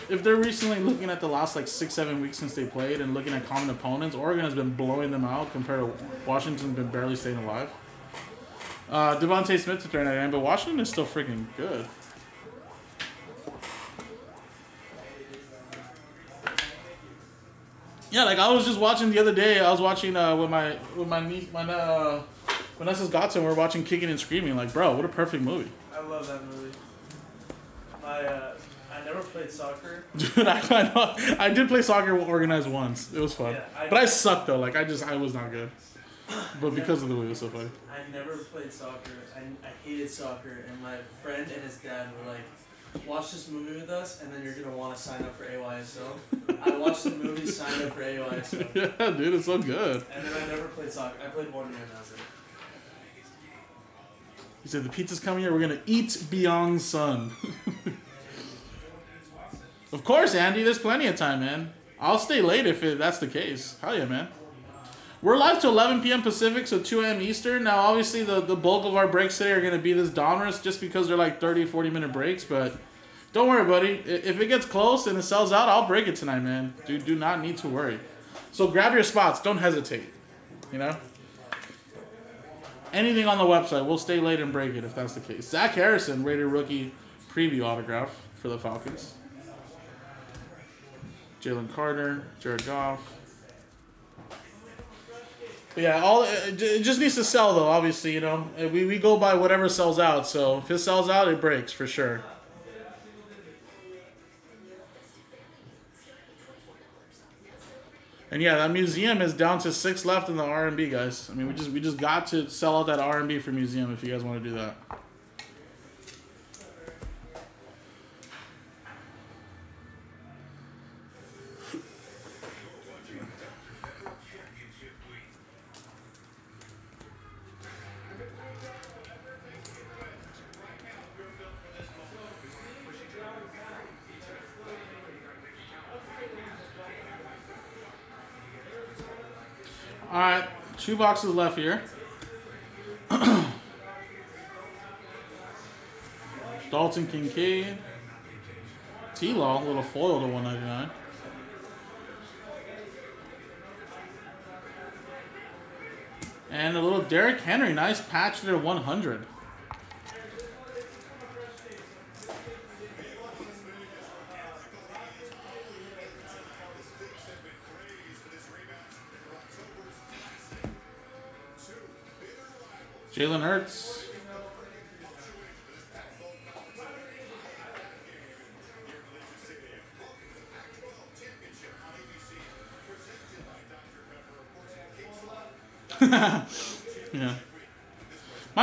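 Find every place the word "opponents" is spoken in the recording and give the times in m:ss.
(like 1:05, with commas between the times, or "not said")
0:03.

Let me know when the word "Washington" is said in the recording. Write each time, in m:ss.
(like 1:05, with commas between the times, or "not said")
0:06, 0:10.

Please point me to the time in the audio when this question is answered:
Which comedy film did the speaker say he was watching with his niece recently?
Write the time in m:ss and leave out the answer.
0:23.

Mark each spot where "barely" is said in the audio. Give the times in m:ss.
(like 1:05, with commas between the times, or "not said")
0:06.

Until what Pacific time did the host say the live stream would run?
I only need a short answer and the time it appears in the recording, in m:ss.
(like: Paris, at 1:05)
11 p.m., at 1:05.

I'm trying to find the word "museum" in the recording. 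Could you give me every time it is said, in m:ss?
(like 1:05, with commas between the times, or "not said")
1:48, 1:53.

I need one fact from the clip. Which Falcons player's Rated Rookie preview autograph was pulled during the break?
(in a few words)
Zach Harrison.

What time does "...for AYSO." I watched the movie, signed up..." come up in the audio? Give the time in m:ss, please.
0:45.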